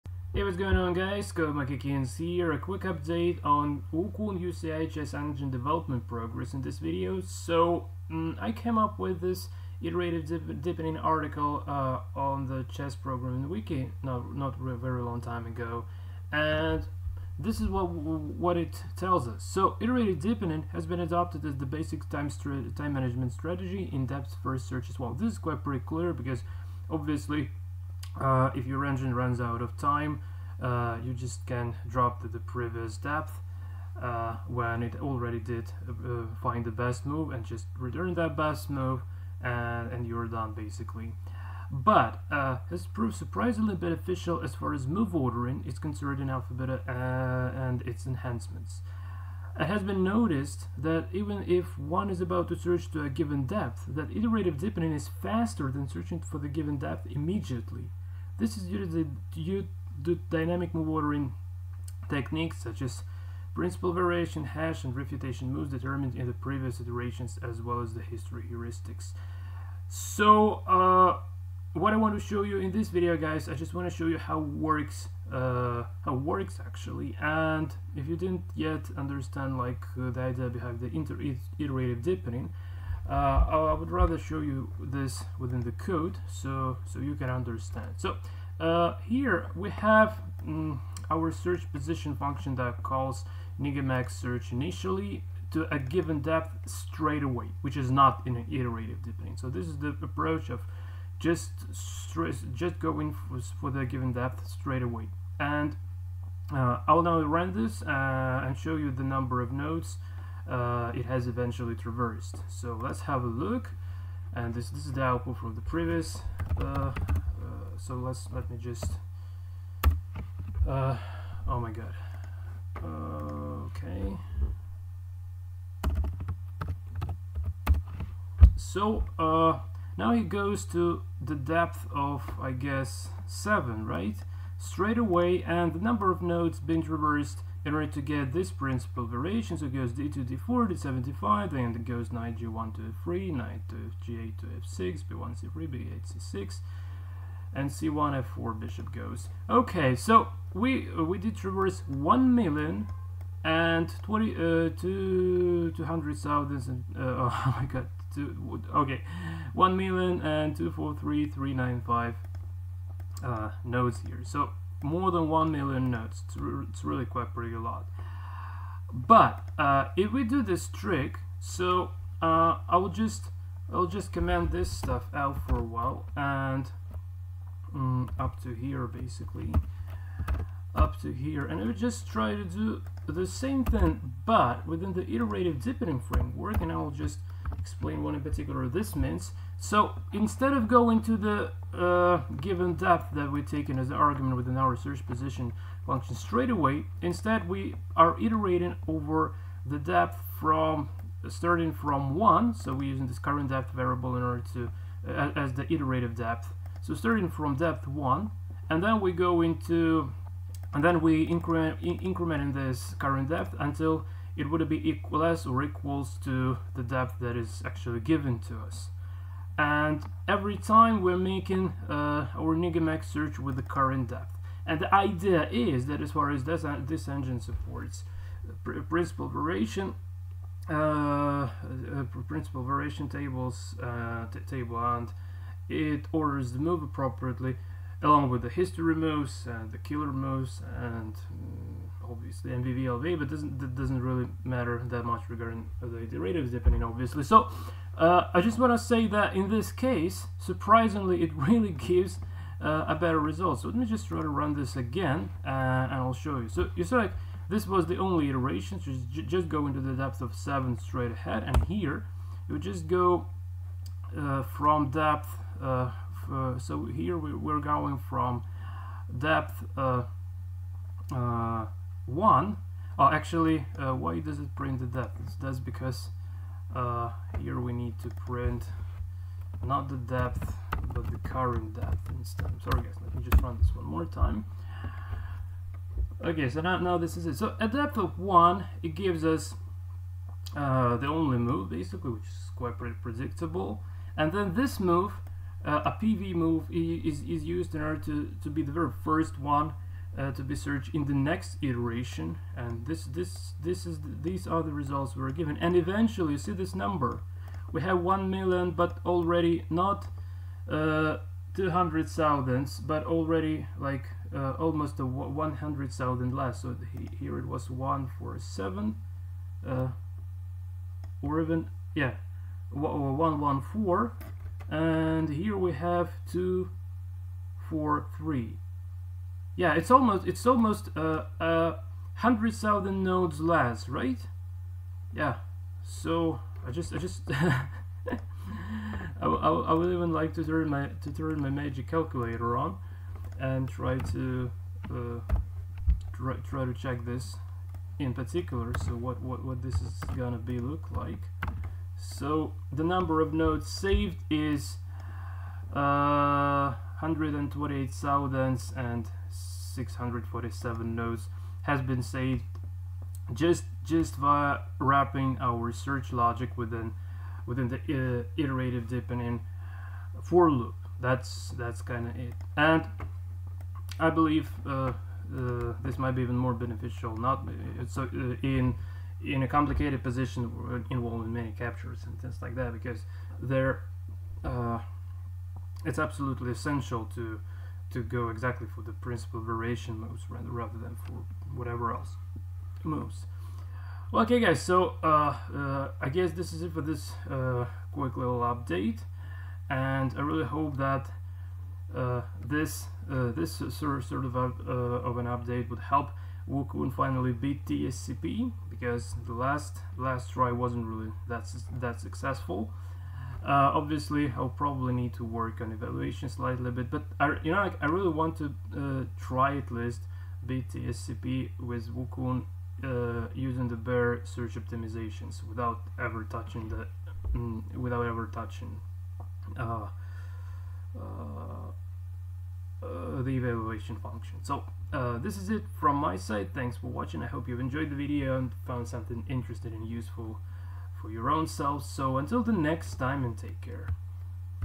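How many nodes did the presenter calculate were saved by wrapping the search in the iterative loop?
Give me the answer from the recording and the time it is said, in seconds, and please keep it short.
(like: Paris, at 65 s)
128,647, at 357 s.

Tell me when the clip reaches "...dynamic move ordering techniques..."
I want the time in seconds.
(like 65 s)
60 s.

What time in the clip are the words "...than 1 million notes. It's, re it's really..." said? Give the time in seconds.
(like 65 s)
165 s.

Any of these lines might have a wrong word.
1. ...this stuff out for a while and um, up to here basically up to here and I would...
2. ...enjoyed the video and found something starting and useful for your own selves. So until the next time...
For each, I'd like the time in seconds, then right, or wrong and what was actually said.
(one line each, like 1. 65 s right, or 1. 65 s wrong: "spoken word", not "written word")
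1. 174 s right
2. 437 s wrong: "interesting", not "starting".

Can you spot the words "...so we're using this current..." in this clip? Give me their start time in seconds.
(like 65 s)
202 s.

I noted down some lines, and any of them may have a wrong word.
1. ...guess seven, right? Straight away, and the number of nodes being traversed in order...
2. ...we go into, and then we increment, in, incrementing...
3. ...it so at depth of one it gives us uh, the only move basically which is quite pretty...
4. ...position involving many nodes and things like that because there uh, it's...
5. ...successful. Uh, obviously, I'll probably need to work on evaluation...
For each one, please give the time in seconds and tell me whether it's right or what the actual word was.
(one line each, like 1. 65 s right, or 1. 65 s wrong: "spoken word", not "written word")
1. 132 s right
2. 209 s right
3. 287 s right
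4. 380 s wrong: "captures", not "nodes"
5. 411 s right.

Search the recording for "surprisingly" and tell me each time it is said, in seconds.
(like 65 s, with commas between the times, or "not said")
43 s, 250 s.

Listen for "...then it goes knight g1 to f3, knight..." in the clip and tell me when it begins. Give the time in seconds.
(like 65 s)
141 s.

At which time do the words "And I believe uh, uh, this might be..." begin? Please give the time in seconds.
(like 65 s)
372 s.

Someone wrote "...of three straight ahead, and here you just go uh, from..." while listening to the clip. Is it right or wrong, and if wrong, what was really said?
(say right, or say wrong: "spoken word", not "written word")
wrong: "seven", not "three".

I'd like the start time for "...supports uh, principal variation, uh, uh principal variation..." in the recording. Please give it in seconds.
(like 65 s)
227 s.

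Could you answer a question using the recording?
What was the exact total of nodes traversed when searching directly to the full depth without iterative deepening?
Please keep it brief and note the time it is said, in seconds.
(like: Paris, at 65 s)
1,243,395, at 159 s.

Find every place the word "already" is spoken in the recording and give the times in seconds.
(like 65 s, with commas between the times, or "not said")
35 s, 309 s, 313 s.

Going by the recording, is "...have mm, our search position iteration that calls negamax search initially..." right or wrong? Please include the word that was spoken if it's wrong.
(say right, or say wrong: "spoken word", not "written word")
wrong: "function", not "iteration".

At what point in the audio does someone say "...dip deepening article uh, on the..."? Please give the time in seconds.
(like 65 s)
10 s.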